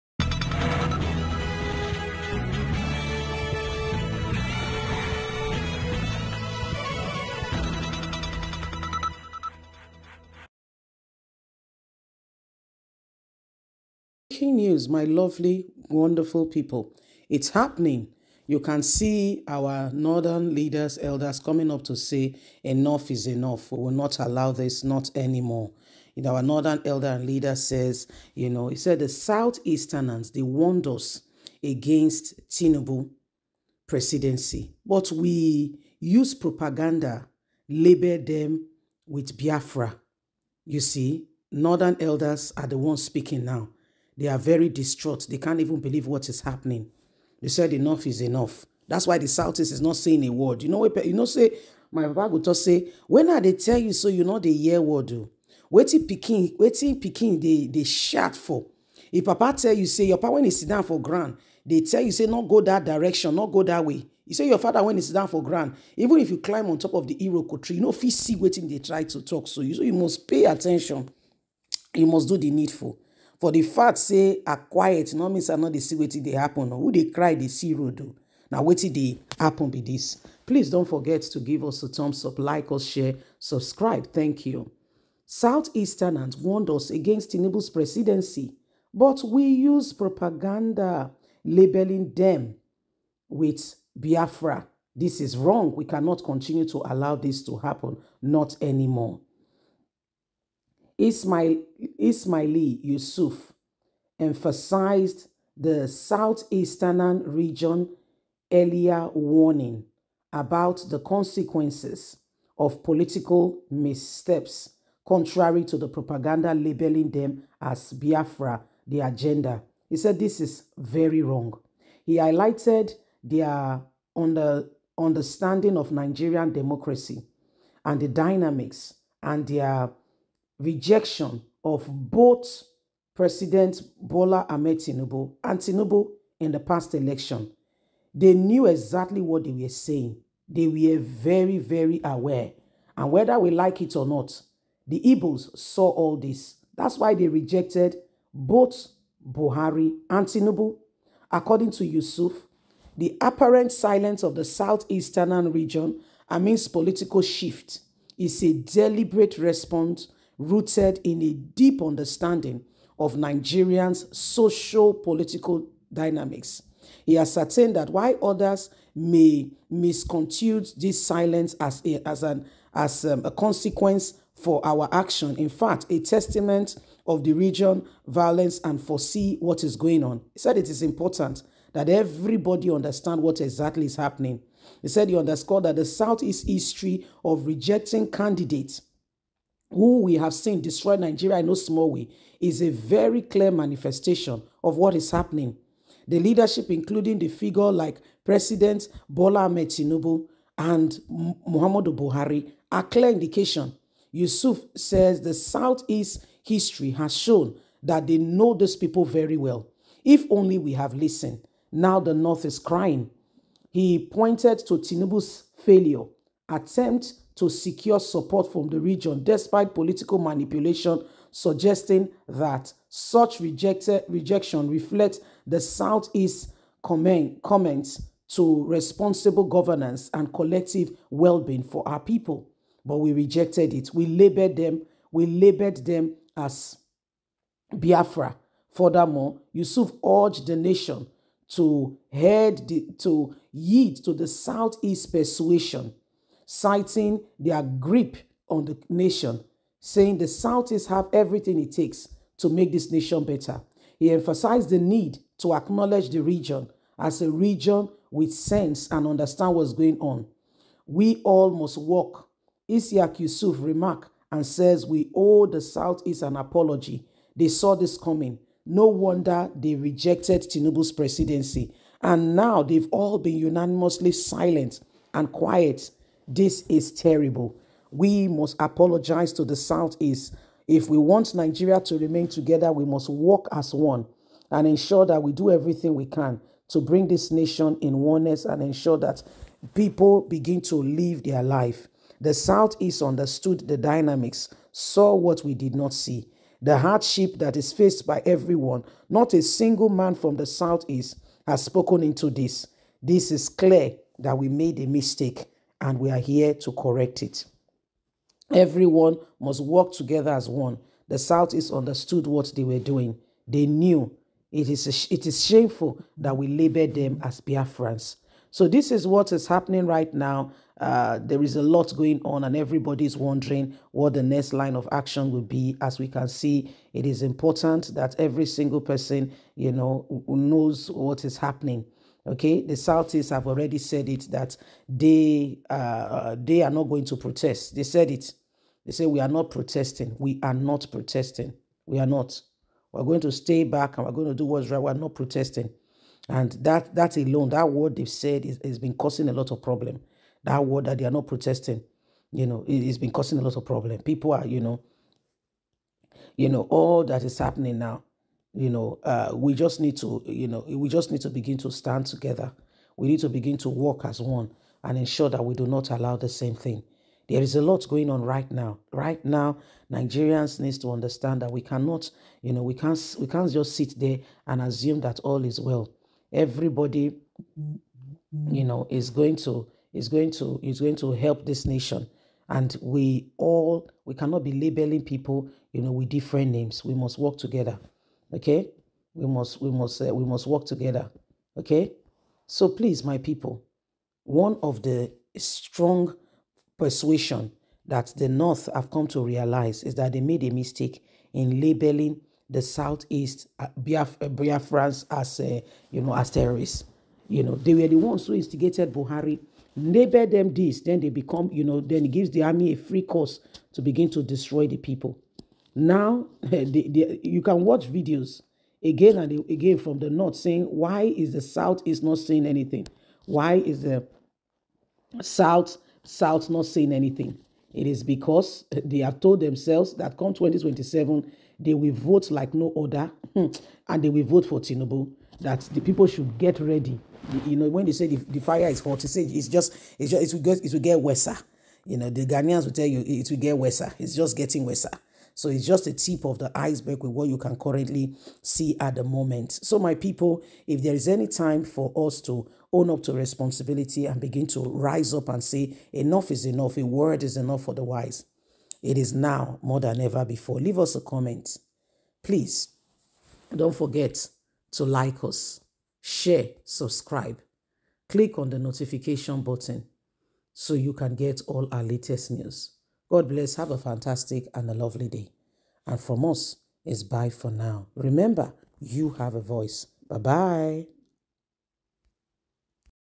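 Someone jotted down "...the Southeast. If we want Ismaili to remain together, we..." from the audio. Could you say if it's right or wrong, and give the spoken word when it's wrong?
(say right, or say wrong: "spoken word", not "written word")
wrong: "Nigeria", not "Ismaili".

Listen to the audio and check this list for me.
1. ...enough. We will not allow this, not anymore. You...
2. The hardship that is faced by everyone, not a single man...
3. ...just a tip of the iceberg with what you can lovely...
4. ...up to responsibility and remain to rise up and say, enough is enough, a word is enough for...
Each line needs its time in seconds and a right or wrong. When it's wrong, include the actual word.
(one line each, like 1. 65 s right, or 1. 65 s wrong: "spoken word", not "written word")
1. 23 s right
2. 296 s right
3. 445 s wrong: "currently", not "lovely"
4. 452 s wrong: "begin", not "remain".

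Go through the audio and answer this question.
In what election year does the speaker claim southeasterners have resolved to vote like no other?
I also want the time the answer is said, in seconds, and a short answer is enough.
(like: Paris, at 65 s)
2027, at 430 s.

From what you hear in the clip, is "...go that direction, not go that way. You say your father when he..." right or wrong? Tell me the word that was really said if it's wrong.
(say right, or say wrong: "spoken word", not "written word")
right.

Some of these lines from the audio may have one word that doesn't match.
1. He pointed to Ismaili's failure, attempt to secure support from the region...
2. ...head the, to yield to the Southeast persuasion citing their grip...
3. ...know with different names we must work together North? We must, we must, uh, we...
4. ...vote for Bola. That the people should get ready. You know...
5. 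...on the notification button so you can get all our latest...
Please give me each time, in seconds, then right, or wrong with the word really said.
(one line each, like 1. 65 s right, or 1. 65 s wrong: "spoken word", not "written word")
1. 213 s wrong: "Tinubu", not "Ismaili"
2. 242 s right
3. 385 s wrong: "Okay", not "North"
4. 434 s wrong: "Tinubu", not "Bola"
5. 468 s right.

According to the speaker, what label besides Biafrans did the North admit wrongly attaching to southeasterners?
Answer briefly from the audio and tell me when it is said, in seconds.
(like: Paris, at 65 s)
terrorists, at 406 s.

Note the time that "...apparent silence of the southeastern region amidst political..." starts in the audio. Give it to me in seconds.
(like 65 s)
153 s.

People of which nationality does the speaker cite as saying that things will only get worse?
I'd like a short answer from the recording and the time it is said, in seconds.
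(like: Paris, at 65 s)
Ghanaians, at 442 s.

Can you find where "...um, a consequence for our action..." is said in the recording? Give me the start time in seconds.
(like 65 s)
173 s.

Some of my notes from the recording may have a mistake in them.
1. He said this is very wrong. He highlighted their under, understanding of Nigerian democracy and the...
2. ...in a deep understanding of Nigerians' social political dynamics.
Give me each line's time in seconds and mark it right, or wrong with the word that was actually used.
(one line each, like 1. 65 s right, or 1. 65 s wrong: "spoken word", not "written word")
1. 119 s right
2. 161 s right.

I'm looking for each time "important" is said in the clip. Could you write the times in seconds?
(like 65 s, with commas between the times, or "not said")
180 s, 327 s.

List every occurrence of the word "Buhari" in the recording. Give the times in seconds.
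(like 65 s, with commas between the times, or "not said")
149 s, 201 s, 408 s.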